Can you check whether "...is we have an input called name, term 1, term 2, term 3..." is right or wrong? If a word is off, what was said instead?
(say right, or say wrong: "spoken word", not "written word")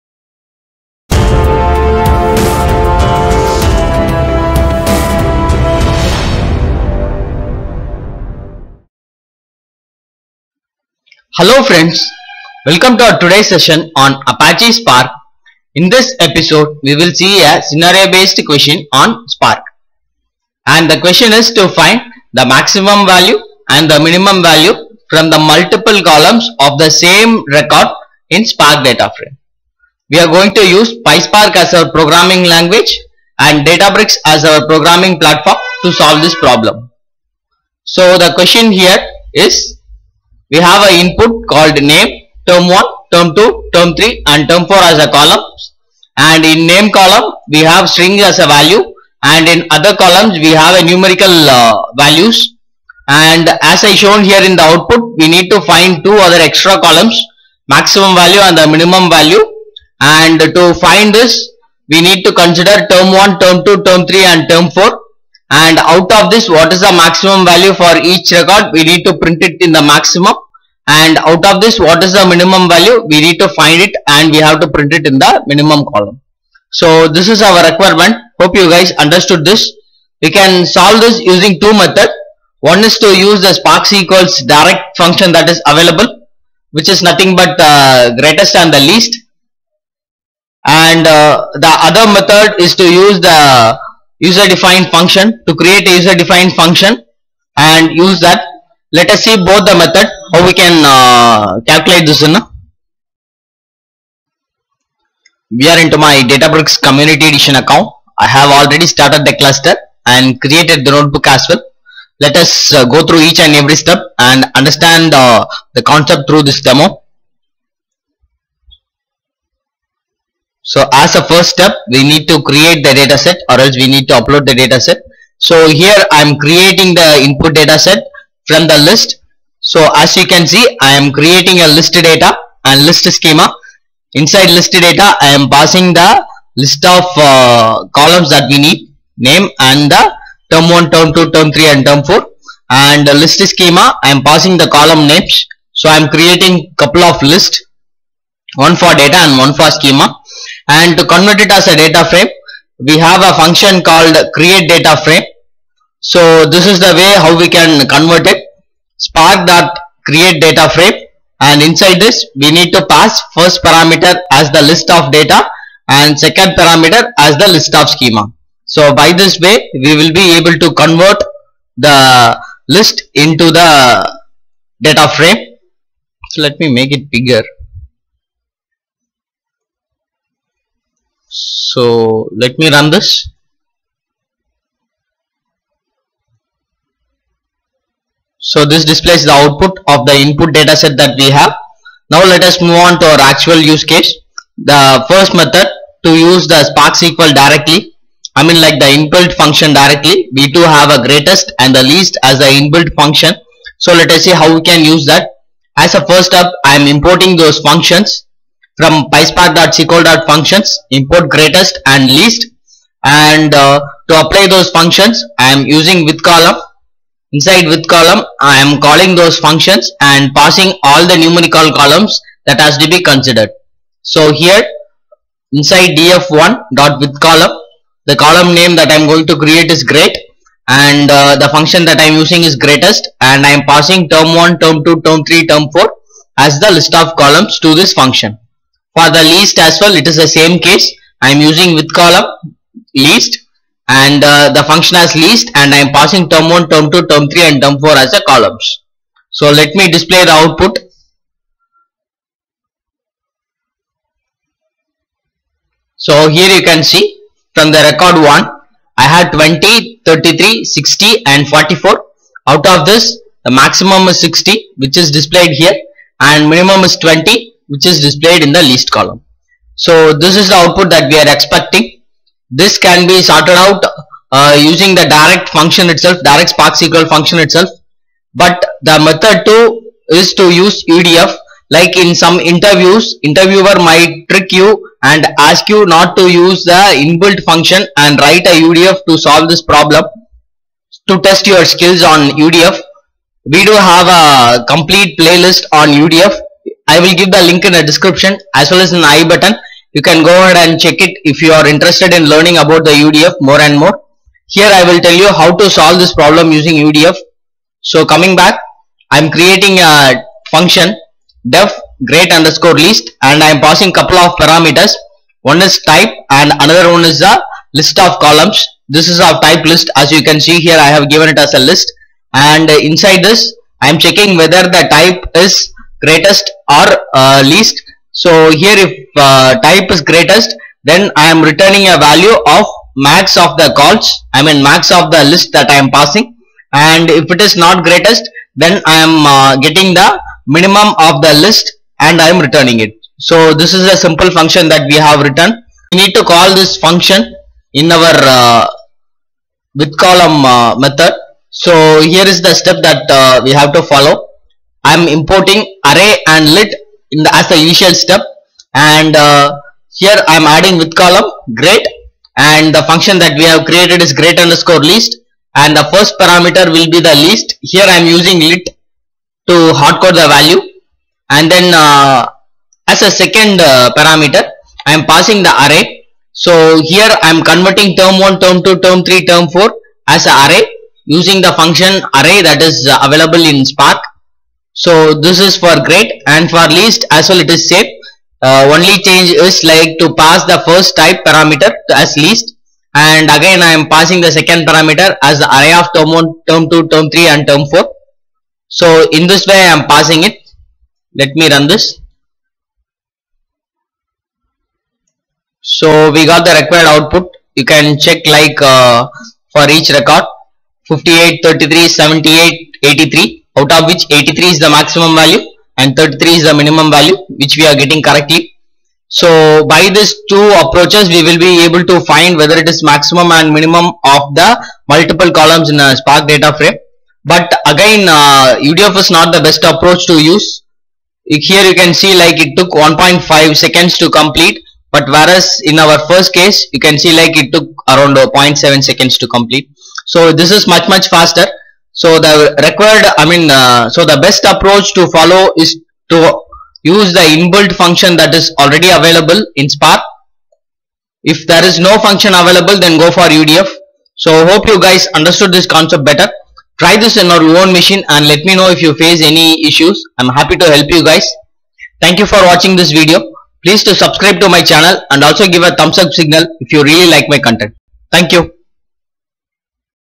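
right.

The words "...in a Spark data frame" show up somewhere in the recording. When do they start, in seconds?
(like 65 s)
425 s.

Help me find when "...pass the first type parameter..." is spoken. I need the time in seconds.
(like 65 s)
390 s.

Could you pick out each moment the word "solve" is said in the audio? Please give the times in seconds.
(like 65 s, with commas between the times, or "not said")
35 s, 80 s, 289 s, 305 s.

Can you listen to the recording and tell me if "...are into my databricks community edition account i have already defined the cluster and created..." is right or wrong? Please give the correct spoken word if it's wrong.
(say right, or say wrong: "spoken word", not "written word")
wrong: "started", not "defined".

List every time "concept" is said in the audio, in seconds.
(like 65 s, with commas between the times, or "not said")
115 s, 455 s.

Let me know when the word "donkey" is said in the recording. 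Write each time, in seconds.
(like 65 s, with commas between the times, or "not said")
not said.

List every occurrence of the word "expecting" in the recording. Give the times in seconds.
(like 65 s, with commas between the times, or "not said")
271 s.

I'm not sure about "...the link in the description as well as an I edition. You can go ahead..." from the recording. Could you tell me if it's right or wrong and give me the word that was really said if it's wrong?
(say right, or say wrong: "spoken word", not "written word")
wrong: "button", not "edition".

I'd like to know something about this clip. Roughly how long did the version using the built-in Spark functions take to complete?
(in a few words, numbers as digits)
0.7 seconds.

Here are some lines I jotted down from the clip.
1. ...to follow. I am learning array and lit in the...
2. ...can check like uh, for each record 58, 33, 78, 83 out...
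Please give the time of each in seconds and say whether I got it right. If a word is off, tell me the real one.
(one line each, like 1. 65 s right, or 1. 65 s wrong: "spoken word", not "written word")
1. 353 s wrong: "importing", not "learning"
2. 407 s right.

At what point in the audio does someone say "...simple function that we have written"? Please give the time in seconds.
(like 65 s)
343 s.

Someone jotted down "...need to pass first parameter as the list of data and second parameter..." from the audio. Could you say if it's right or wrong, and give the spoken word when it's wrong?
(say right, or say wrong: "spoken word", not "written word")
right.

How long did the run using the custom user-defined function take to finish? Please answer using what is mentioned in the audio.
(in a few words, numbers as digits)
1.5 seconds.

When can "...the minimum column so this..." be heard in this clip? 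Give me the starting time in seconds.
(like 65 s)
75 s.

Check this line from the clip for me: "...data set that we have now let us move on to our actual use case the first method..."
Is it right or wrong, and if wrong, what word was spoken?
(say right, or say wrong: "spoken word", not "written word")
right.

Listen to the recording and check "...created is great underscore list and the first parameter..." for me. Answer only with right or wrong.
right.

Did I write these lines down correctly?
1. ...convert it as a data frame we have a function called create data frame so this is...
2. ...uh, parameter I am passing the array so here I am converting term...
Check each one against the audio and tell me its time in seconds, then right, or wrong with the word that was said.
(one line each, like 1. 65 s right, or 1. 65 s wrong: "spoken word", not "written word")
1. 151 s right
2. 373 s right.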